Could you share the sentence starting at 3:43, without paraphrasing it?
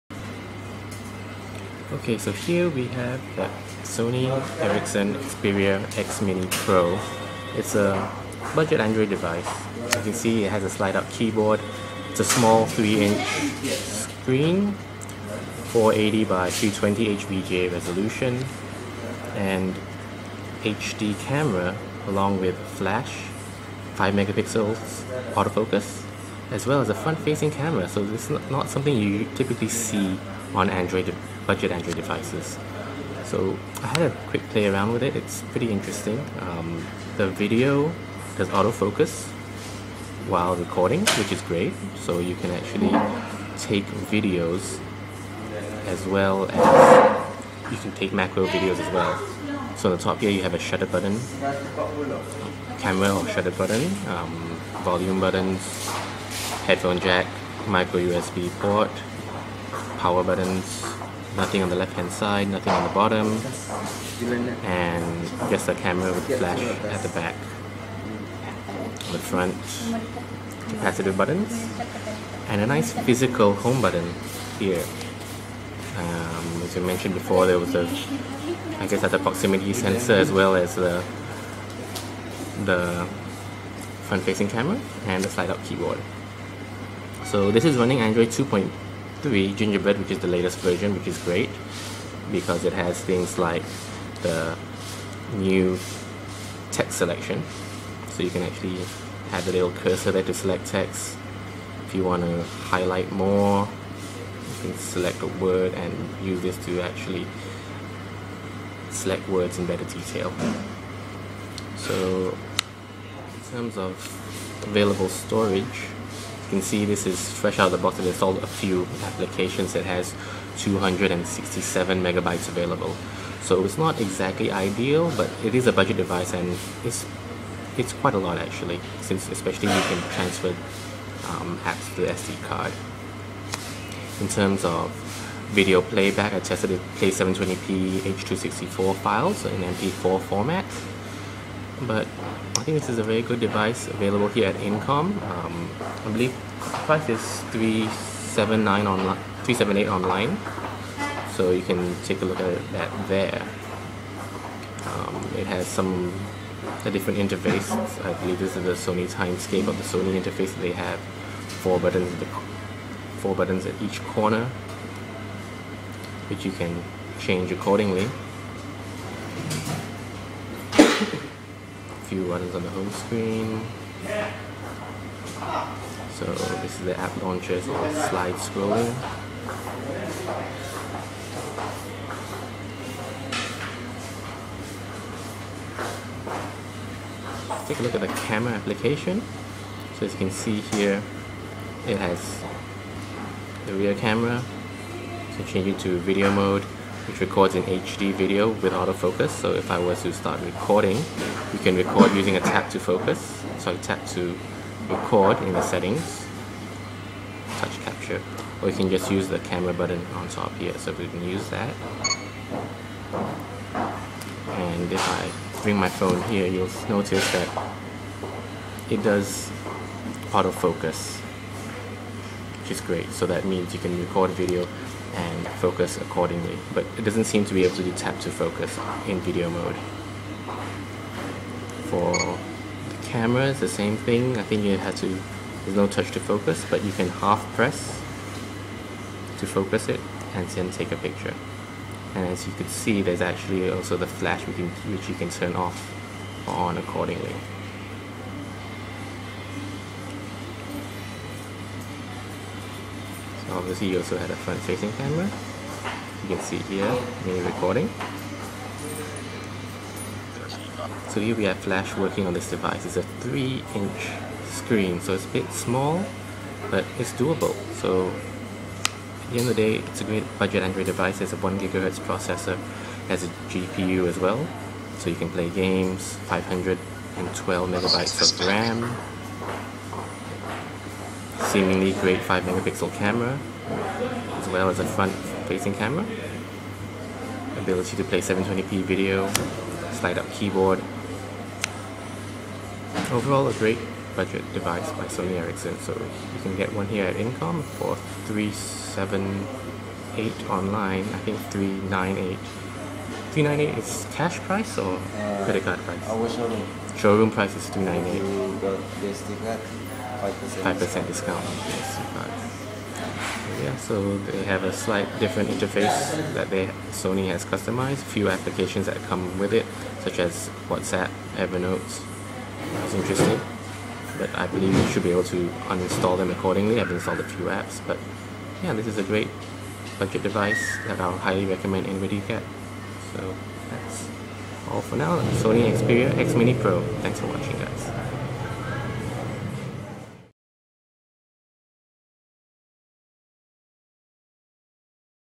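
So that means you can record video and focus accordingly.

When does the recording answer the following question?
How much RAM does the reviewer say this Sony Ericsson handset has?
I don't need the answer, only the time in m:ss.
4:36.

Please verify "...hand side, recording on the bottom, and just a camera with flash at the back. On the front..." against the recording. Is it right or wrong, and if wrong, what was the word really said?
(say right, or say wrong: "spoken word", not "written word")
wrong: "nothing", not "recording".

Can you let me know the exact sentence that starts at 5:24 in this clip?
but I believe you should be able to uninstall them accordingly.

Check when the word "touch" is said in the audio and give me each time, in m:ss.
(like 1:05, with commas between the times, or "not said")
3:27, 3:55.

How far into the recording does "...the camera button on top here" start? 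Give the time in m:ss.
3:29.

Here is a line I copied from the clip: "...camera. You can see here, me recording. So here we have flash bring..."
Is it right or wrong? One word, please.
wrong.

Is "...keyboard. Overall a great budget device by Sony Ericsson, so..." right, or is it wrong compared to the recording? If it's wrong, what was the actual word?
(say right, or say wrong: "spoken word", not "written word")
right.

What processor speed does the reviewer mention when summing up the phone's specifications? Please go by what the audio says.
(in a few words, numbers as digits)
1 gigahertz.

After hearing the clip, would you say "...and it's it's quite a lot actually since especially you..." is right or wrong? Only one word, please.
right.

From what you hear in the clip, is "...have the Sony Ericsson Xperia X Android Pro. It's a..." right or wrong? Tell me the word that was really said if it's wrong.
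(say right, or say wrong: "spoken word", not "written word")
wrong: "Mini", not "Android".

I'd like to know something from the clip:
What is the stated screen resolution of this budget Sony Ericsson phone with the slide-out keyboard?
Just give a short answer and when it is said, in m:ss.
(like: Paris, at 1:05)
480 by 320, at 0:15.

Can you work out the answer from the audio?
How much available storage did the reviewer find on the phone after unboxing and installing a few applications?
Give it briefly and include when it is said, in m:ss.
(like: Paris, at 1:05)
267 megabytes, at 2:00.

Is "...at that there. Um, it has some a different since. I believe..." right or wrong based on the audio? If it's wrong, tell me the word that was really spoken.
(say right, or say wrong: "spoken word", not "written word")
wrong: "interface", not "since".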